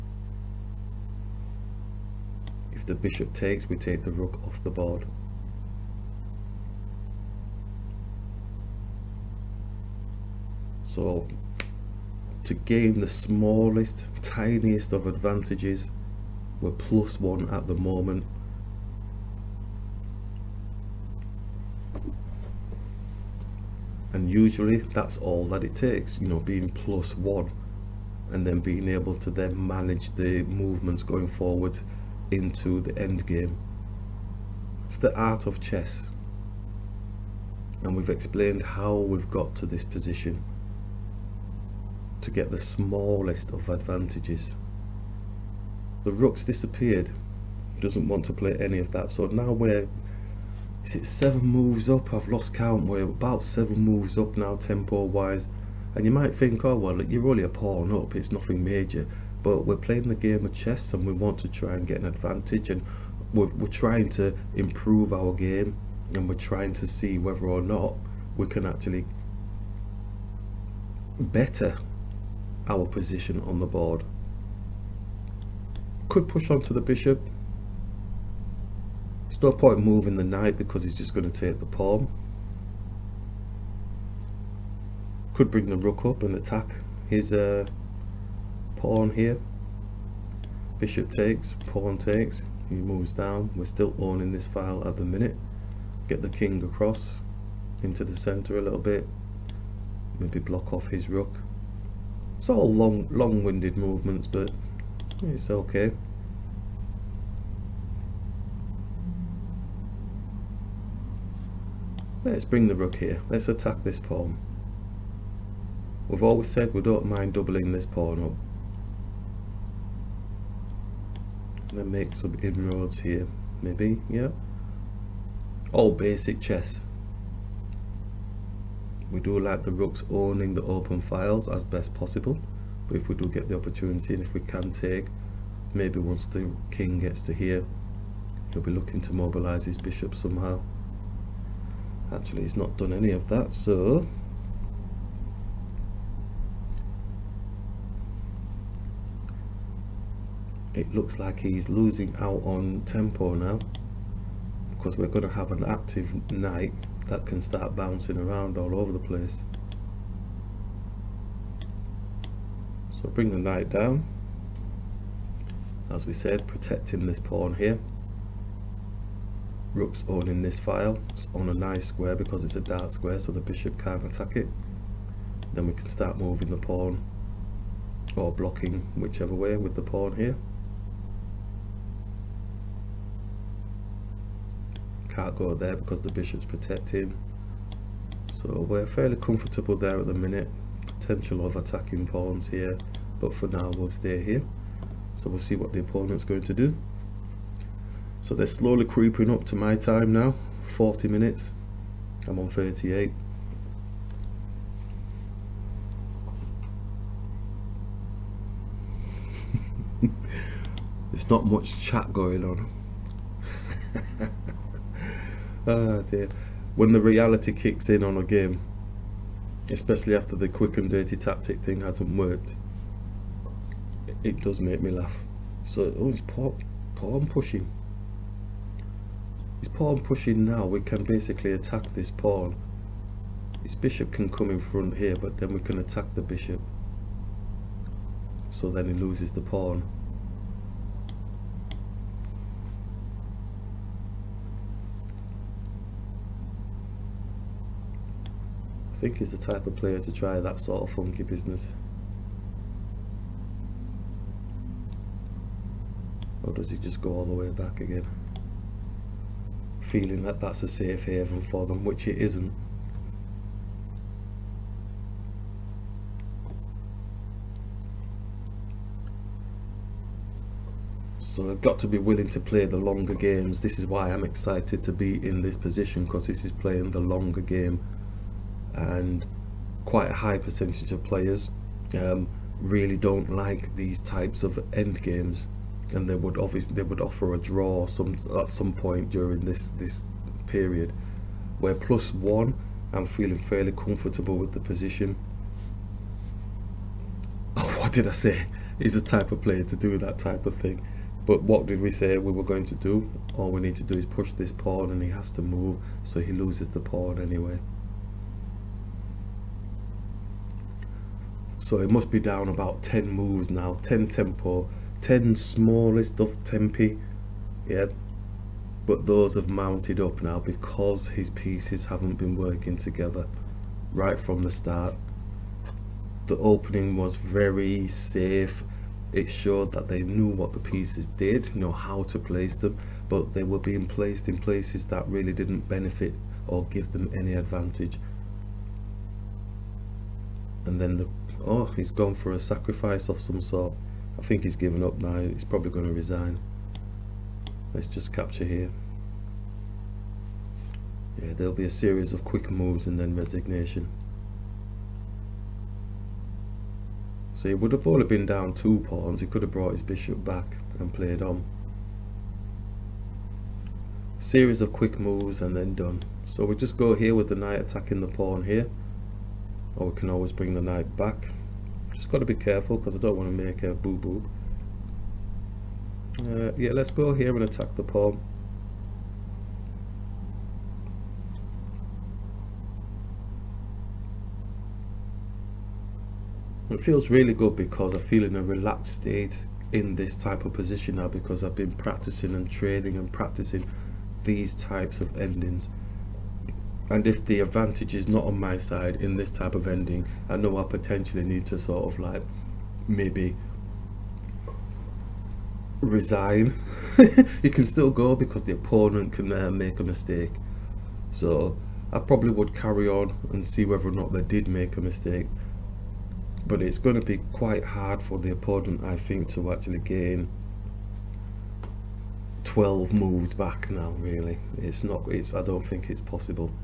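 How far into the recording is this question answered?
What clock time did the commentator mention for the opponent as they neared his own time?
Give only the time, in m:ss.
3:20.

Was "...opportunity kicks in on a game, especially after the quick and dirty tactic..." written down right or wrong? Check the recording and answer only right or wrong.
wrong.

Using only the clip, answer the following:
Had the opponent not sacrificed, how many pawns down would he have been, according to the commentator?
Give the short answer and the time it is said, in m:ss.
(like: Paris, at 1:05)
2, at 5:58.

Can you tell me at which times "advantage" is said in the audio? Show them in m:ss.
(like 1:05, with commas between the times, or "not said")
0:15, 0:43, 1:02, 5:37, 6:37.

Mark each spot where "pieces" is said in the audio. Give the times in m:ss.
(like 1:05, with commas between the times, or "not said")
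5:21, 5:30.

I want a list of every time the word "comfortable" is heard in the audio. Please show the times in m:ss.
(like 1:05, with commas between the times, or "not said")
3:09, 4:53.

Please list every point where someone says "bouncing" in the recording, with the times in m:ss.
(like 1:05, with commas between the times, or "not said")
2:37.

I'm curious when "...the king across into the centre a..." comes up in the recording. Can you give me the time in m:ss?
1:36.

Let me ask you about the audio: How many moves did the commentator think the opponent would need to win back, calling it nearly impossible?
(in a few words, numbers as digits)
12.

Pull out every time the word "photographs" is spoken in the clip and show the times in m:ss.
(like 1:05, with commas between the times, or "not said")
not said.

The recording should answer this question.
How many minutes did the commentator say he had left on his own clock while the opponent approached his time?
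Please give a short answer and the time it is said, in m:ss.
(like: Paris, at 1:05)
38, at 3:22.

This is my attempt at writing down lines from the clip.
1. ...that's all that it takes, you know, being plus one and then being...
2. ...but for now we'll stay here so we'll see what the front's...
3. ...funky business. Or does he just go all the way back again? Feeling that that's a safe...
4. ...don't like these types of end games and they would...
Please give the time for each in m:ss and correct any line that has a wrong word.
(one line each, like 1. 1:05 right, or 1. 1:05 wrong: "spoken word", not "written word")
1. 0:24 right
2. 3:13 wrong: "opponent", not "front"
3. 4:10 right
4. 4:42 right.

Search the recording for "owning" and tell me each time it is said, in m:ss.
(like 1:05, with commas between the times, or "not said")
1:33, 2:10, 2:50.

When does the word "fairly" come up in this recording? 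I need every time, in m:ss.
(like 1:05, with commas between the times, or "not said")
3:08, 4:53.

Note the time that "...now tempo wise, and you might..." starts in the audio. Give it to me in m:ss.
0:54.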